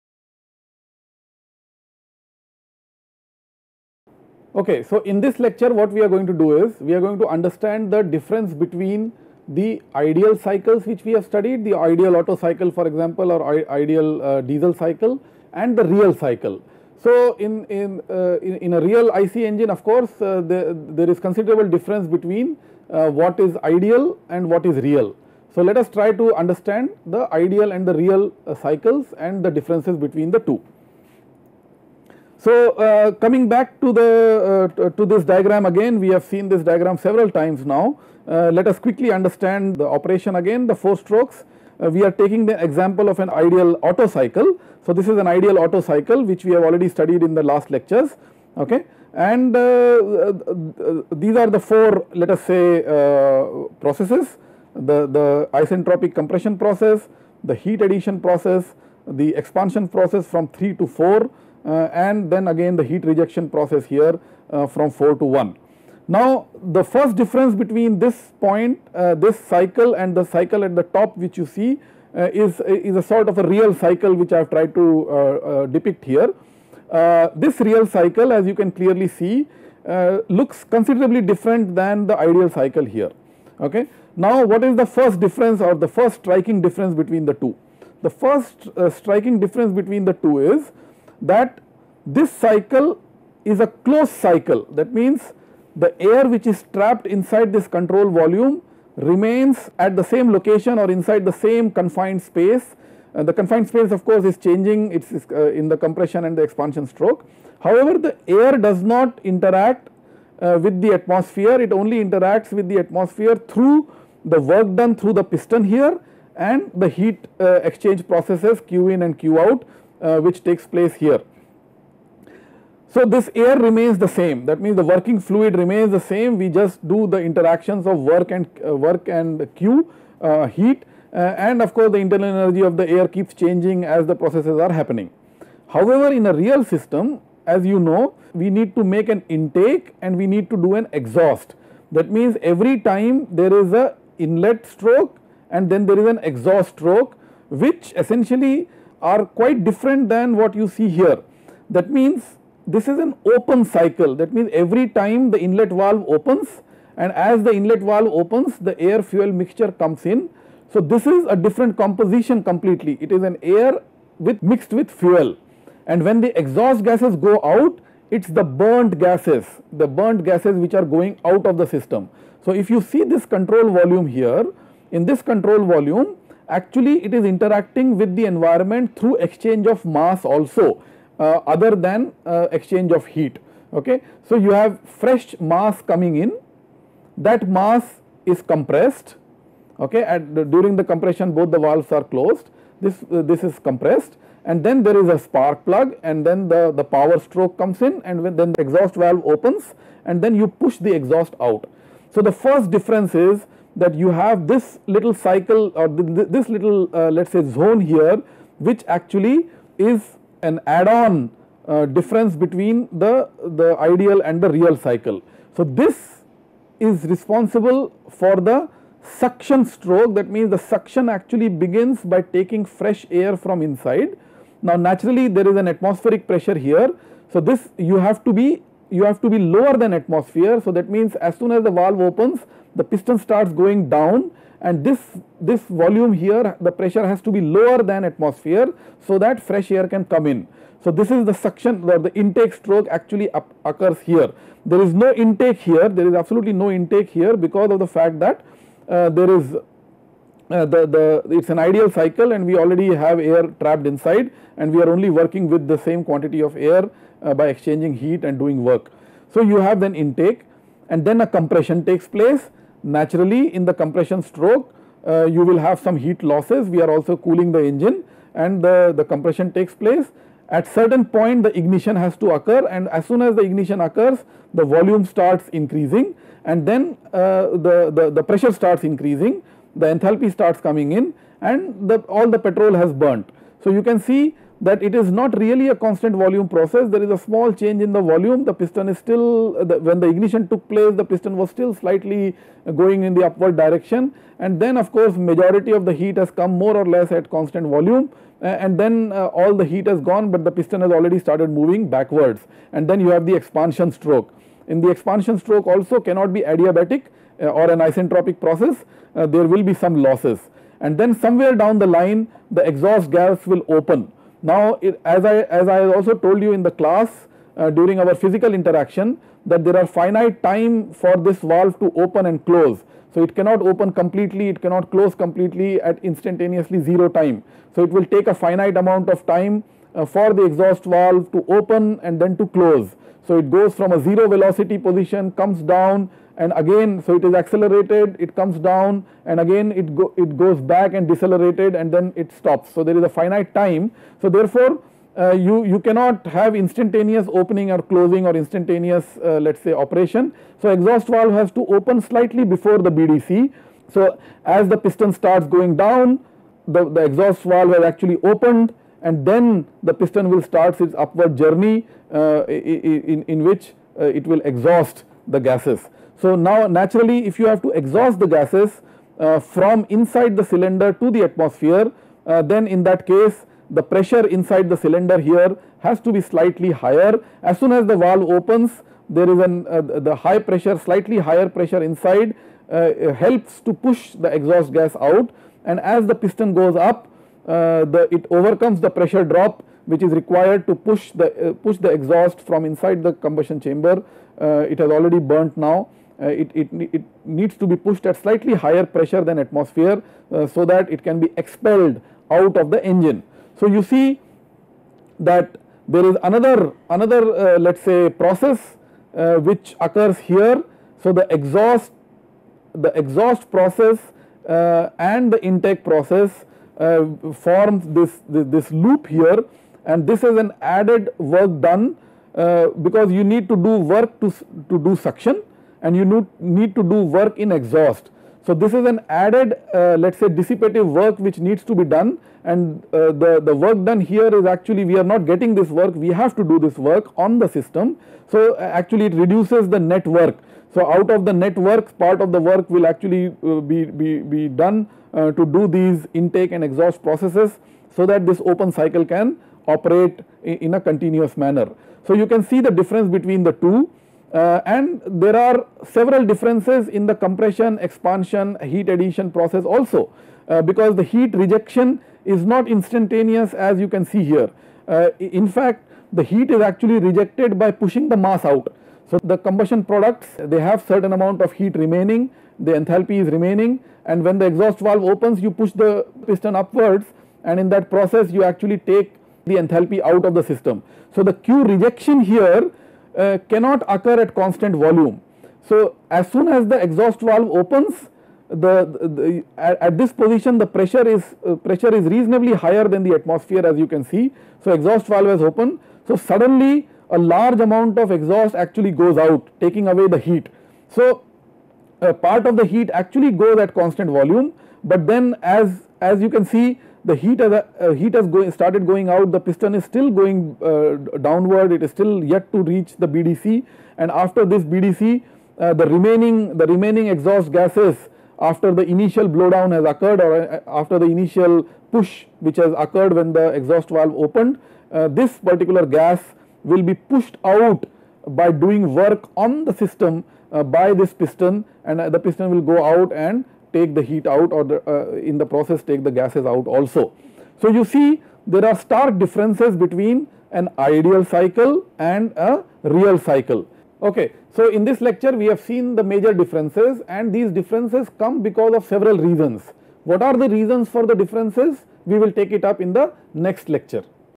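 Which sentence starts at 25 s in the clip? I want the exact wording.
So, let us try to understand the ideal and the real uh, cycles and the differences between the two.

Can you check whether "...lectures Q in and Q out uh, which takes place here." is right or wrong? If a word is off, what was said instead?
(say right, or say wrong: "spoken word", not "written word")
wrong: "processes", not "lectures".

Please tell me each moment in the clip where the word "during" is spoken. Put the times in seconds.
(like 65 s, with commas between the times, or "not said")
190 s, 317 s.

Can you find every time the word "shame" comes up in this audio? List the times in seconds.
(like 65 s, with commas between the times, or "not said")
not said.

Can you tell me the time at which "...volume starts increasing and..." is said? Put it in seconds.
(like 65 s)
274 s.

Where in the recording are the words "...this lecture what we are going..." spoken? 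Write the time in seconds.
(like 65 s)
5 s.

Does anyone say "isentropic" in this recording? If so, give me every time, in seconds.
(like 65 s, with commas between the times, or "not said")
55 s, 307 s.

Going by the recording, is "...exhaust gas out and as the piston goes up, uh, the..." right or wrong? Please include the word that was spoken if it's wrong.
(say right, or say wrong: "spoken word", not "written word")
right.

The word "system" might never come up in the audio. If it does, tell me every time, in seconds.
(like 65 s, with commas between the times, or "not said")
136 s, 171 s, 437 s, 480 s, 529 s.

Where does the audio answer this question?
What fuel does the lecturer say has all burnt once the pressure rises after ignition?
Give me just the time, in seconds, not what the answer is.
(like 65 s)
282 s.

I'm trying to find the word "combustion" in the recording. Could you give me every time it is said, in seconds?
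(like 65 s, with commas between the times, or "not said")
393 s, 469 s.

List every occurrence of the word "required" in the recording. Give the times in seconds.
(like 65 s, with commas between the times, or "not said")
390 s.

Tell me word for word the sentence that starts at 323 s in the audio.
So, it cannot open completely, it cannot close completely at instantaneously 0 time.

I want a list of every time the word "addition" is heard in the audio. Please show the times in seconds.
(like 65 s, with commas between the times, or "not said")
57 s, 458 s.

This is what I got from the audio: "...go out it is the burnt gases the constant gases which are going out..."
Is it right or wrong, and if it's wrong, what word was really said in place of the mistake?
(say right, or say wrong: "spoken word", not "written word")
wrong: "burnt", not "constant".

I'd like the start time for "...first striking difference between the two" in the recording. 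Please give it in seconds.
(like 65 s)
85 s.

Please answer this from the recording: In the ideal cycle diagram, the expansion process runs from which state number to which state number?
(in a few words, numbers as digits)
3 to 4.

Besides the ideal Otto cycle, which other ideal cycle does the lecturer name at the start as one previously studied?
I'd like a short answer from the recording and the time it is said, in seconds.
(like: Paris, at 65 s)
Diesel cycle, at 14 s.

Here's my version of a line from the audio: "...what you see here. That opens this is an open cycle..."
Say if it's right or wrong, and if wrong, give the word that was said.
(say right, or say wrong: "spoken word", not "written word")
wrong: "means", not "opens".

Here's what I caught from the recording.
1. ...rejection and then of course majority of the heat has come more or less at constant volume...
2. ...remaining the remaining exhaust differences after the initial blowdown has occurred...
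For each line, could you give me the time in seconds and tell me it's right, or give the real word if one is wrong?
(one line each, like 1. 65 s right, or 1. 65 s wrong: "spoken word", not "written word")
1. 293 s wrong: "direction", not "rejection"
2. 515 s wrong: "gases", not "differences".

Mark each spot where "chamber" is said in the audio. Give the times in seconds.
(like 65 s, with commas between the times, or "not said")
393 s.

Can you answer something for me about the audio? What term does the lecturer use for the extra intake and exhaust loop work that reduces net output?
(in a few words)
Dissipative work.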